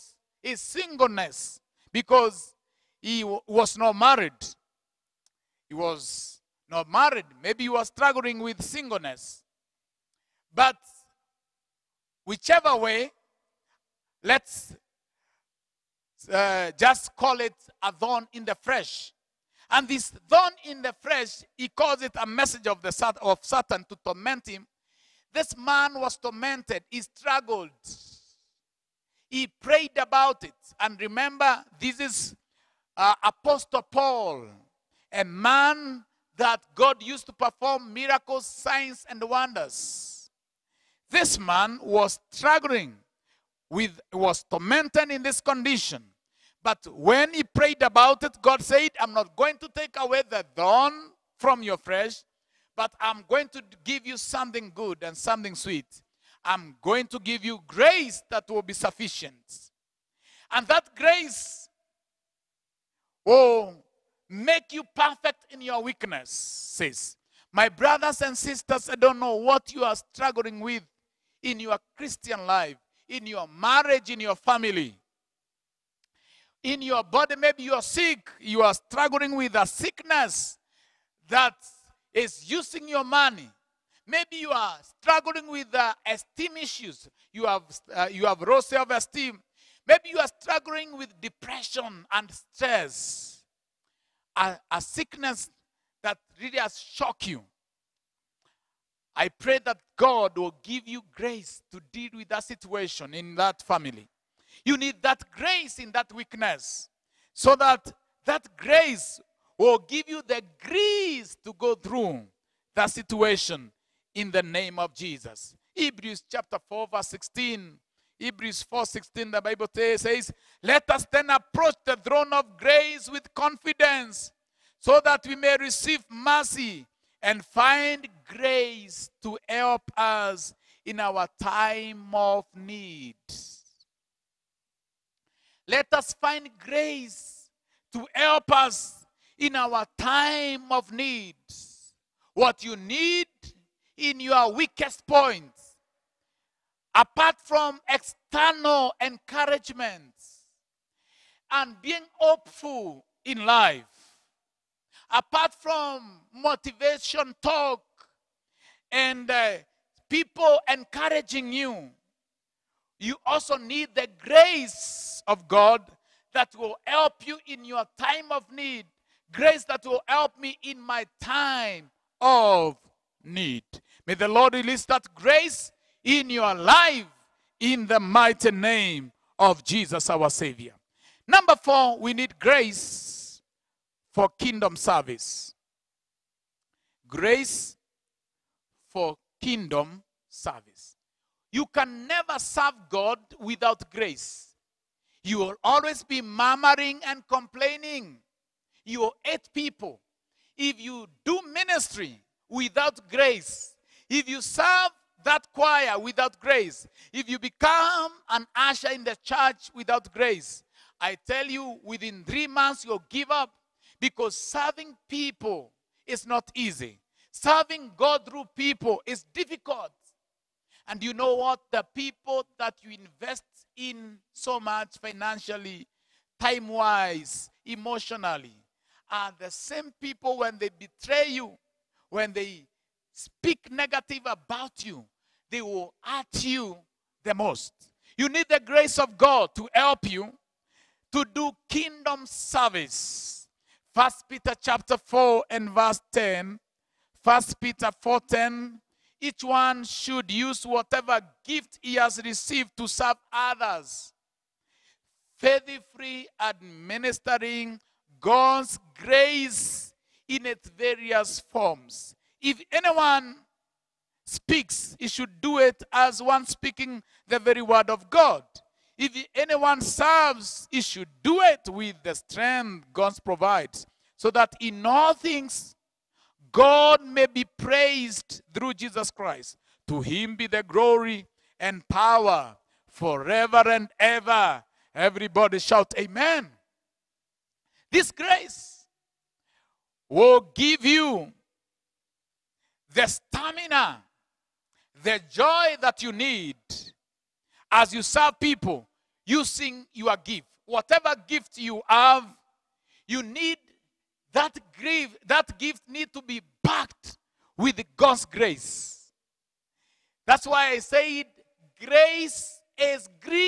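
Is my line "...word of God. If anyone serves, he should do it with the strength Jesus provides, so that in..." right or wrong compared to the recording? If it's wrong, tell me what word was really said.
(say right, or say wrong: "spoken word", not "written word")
wrong: "God", not "Jesus".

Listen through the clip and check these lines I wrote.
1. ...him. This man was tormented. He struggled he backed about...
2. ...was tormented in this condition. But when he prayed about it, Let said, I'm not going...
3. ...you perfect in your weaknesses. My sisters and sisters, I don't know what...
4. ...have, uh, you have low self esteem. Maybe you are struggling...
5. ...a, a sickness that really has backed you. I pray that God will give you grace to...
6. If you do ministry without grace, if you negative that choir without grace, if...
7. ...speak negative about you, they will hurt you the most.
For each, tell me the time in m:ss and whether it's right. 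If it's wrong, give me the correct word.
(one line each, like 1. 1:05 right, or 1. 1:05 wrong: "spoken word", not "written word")
1. 0:24 wrong: "prayed", not "backed"
2. 0:44 wrong: "God", not "Let"
3. 1:04 wrong: "brothers", not "sisters"
4. 1:27 right
5. 1:34 wrong: "shocked", not "backed"
6. 3:20 wrong: "serve", not "negative"
7. 3:53 right.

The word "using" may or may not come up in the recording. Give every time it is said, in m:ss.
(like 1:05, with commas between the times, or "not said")
1:22, 4:59.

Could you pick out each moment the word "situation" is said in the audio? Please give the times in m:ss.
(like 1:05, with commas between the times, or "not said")
1:42, 1:52.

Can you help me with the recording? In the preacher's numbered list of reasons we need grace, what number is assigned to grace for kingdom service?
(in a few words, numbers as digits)
4.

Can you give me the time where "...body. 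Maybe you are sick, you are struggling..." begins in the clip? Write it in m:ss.
1:17.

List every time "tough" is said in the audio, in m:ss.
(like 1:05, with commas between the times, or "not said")
not said.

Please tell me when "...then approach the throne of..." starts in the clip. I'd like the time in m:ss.
2:01.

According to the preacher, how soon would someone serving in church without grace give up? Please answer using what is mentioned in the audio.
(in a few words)
Three months.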